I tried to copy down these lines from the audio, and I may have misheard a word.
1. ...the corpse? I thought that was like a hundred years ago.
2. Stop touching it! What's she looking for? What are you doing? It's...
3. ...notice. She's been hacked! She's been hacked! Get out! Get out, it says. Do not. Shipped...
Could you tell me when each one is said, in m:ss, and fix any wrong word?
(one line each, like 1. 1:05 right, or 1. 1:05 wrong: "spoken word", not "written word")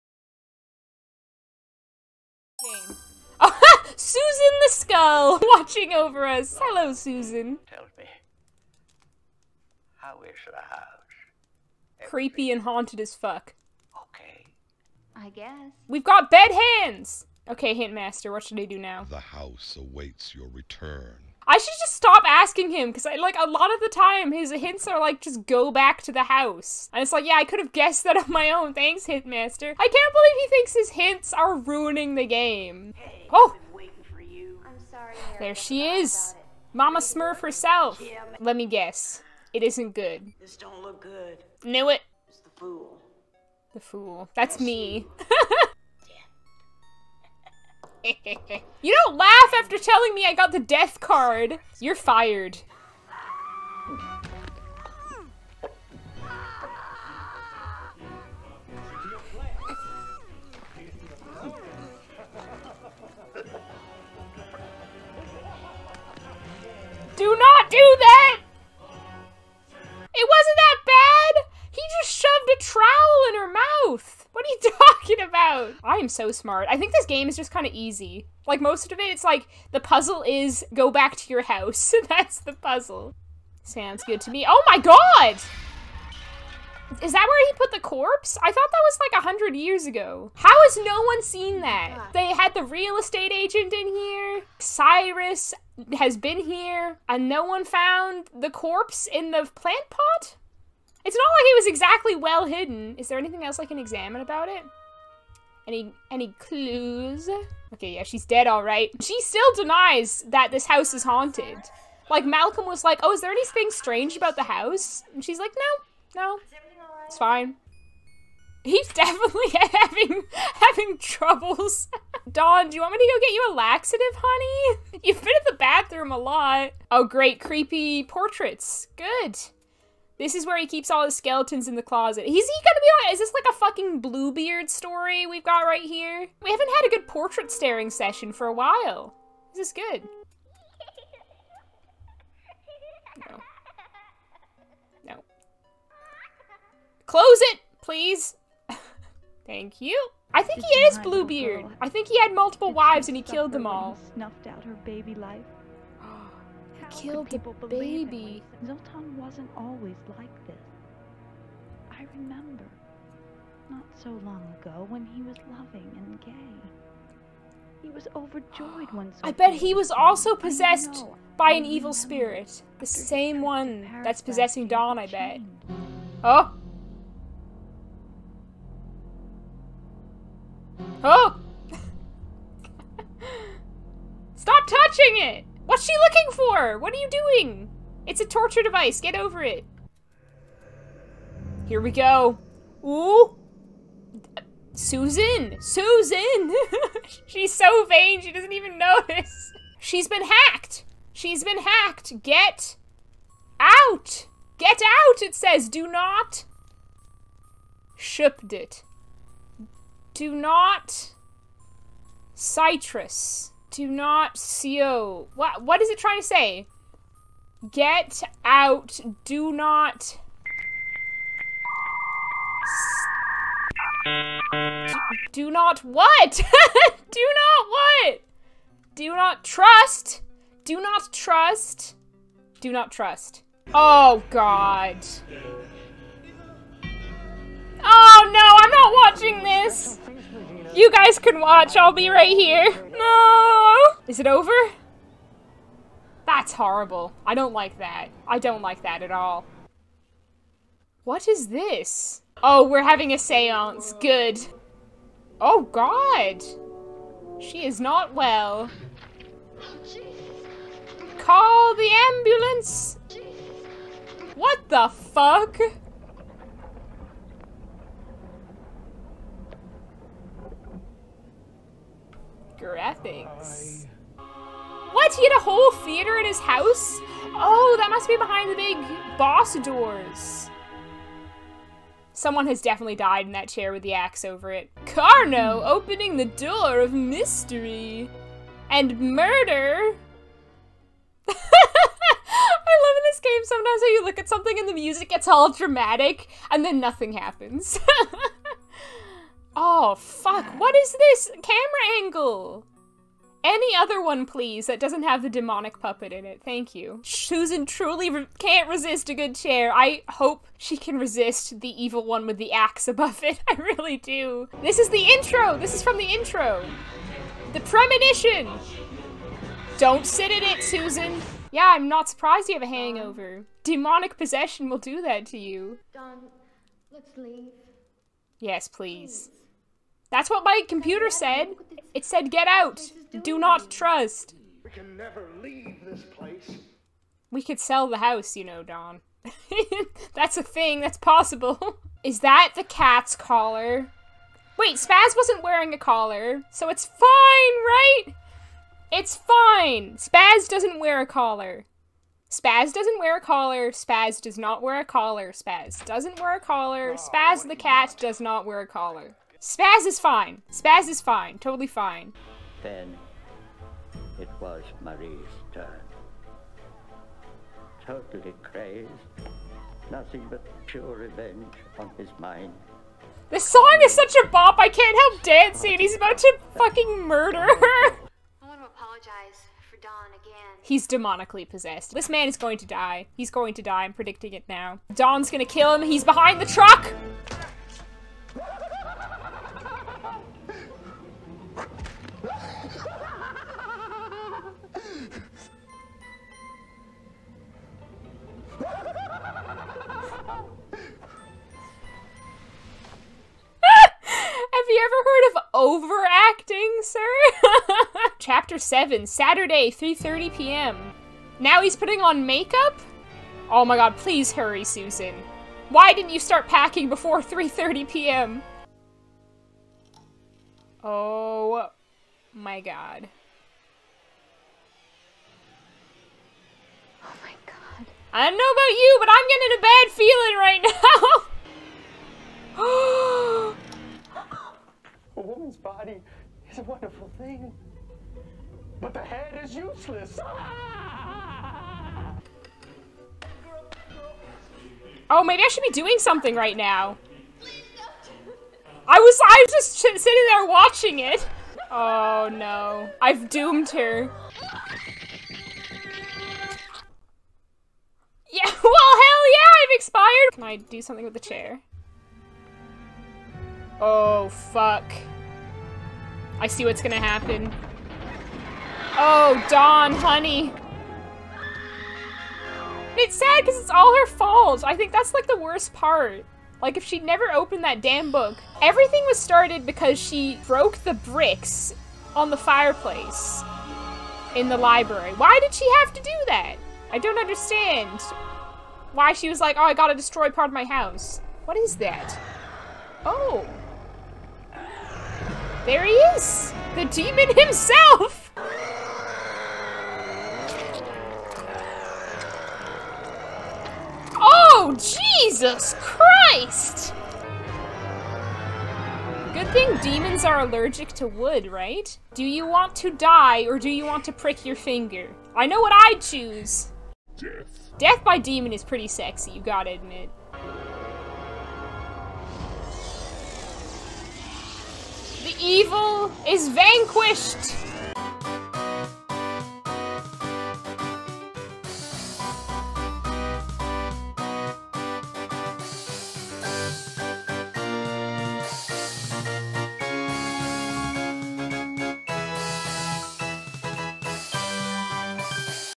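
1. 1:27 right
2. 3:04 right
3. 3:18 right.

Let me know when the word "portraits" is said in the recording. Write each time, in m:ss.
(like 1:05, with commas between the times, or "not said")
2:08, 2:17.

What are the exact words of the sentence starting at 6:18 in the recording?
I want to apologize for Don again.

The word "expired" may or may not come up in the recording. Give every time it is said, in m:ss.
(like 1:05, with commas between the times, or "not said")
7:39.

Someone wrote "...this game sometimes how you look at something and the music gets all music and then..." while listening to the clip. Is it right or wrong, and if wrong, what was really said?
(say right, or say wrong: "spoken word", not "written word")
wrong: "dramatic", not "music".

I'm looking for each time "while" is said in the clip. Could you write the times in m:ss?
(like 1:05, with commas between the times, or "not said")
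2:18.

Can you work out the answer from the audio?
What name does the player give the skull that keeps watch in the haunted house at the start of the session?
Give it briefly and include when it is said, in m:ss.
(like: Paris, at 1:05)
Susan the Skull, at 0:03.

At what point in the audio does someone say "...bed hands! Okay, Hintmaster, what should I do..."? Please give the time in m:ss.
0:16.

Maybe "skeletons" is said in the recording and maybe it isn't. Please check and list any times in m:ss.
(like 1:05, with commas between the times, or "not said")
2:11.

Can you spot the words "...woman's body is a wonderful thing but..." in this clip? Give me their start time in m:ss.
7:15.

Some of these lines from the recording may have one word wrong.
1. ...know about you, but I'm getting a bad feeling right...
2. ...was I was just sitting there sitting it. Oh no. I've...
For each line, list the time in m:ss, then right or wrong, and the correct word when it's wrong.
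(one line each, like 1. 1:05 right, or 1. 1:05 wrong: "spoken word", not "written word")
1. 7:08 right
2. 7:28 wrong: "watching", not "sitting".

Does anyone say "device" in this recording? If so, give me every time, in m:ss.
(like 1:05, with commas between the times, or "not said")
3:08.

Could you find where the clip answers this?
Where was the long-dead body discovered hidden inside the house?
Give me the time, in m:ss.
1:39.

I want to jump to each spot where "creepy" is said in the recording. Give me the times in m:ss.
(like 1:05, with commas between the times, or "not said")
0:12, 2:07.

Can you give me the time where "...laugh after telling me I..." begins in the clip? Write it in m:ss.
0:49.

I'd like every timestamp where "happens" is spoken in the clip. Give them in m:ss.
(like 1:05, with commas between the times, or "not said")
4:57, 7:46.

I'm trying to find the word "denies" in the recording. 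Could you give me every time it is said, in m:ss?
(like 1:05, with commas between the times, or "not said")
1:49.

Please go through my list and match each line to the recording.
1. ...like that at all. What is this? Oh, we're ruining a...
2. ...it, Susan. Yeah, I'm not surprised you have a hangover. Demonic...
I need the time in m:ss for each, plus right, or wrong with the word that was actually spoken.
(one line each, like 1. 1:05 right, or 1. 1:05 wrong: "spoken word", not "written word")
1. 4:08 wrong: "having", not "ruining"
2. 5:20 right.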